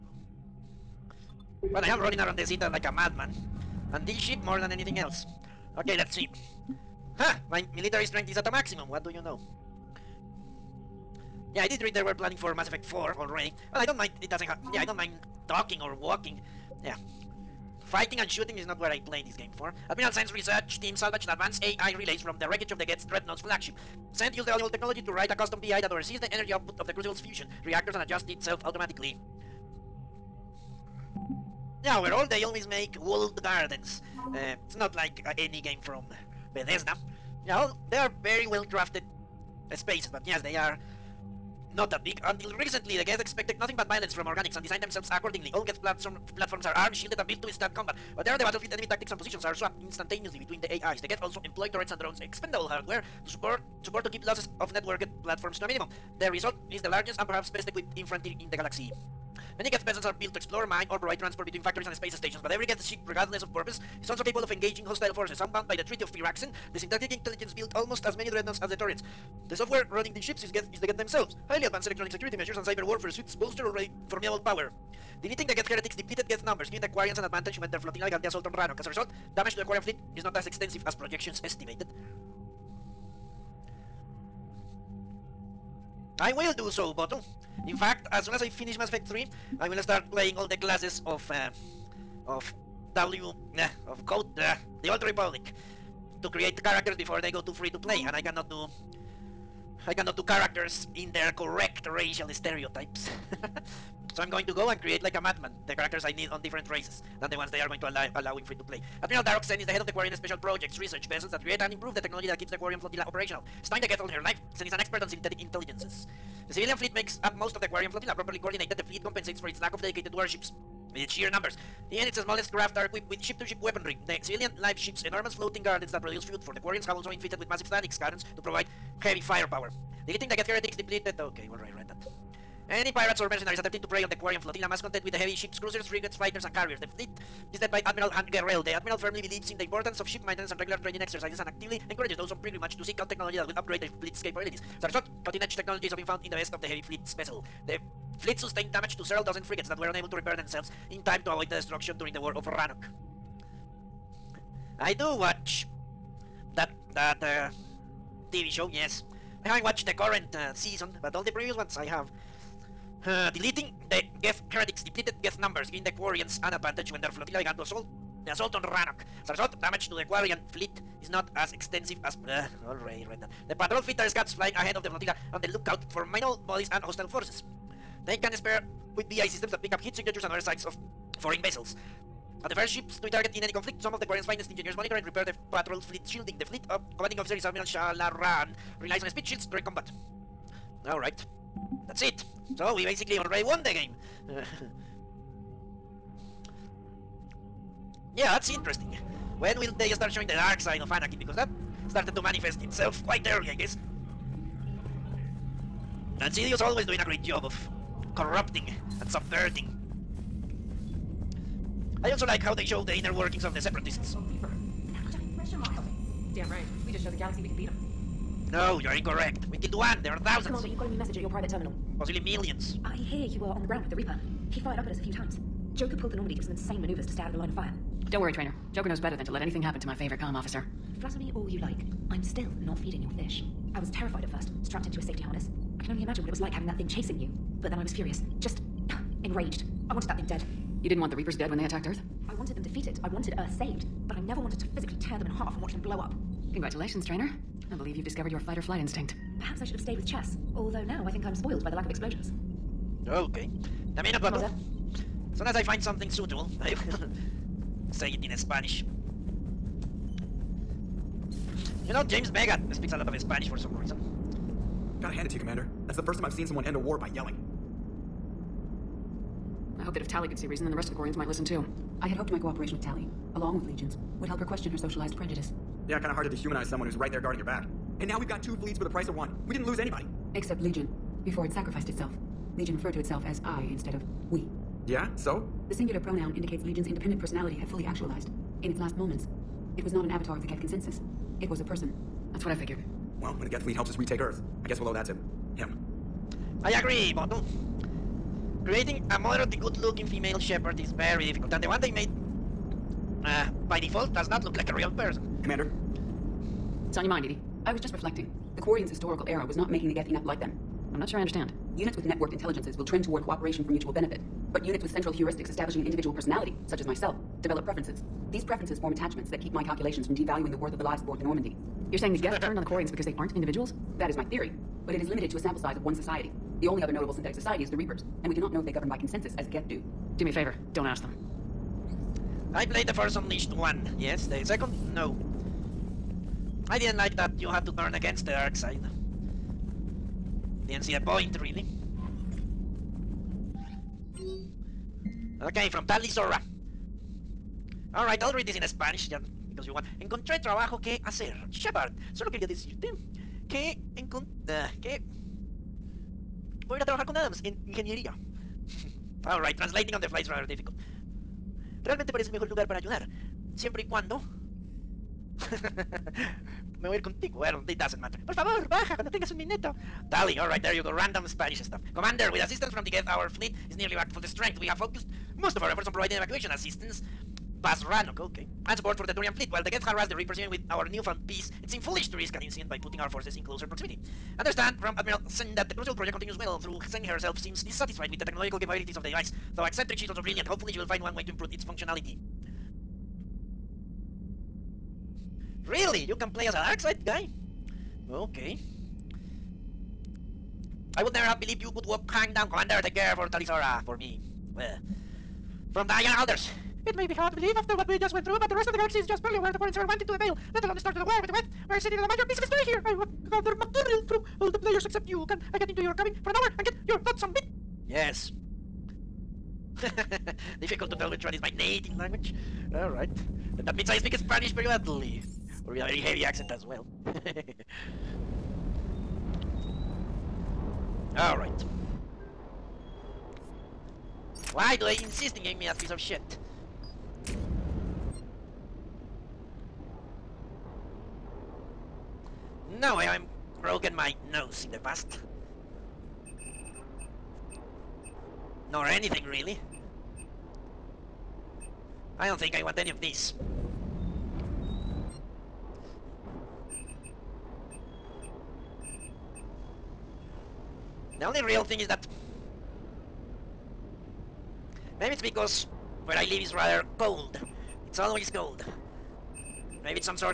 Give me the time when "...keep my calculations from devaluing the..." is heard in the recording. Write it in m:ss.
5:19.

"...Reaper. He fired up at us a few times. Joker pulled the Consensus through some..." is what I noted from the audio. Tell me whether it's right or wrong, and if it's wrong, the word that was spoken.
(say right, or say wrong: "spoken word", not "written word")
wrong: "Normandy", not "Consensus".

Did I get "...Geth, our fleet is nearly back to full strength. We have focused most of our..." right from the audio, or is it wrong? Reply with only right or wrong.
right.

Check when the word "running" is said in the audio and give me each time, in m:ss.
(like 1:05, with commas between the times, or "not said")
0:01, 1:09.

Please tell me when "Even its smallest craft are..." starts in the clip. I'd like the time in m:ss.
2:01.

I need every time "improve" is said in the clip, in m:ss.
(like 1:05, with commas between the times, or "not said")
1:51, 6:31.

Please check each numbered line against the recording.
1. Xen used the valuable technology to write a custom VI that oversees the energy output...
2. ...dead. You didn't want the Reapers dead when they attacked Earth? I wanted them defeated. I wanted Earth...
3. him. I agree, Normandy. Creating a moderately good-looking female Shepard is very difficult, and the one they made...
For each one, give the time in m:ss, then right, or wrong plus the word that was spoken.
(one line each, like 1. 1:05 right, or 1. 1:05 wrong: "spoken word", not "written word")
1. 0:24 right
2. 4:00 right
3. 4:55 wrong: "Bottom", not "Normandy".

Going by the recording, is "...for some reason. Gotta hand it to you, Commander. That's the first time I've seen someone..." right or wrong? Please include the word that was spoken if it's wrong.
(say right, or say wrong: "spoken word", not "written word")
right.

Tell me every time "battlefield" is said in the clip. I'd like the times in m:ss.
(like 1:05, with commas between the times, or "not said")
0:48.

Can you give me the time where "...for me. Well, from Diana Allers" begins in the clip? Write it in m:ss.
6:43.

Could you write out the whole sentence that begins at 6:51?
We're sitting on a major piece of history here.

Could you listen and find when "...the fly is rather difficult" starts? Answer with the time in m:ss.
6:00.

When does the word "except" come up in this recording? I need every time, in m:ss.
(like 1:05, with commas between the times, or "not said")
4:40, 6:54.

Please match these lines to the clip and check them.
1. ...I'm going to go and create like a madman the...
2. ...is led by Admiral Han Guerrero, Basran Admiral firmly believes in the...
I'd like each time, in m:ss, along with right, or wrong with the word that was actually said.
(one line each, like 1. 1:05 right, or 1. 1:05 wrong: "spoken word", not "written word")
1. 1:44 right
2. 2:17 wrong: "The", not "Basran".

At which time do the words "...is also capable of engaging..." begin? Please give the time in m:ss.
1:04.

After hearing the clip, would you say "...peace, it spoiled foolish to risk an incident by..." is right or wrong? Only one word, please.
wrong.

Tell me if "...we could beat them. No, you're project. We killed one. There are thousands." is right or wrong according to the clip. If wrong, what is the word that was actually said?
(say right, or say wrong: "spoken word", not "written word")
wrong: "incorrect", not "project".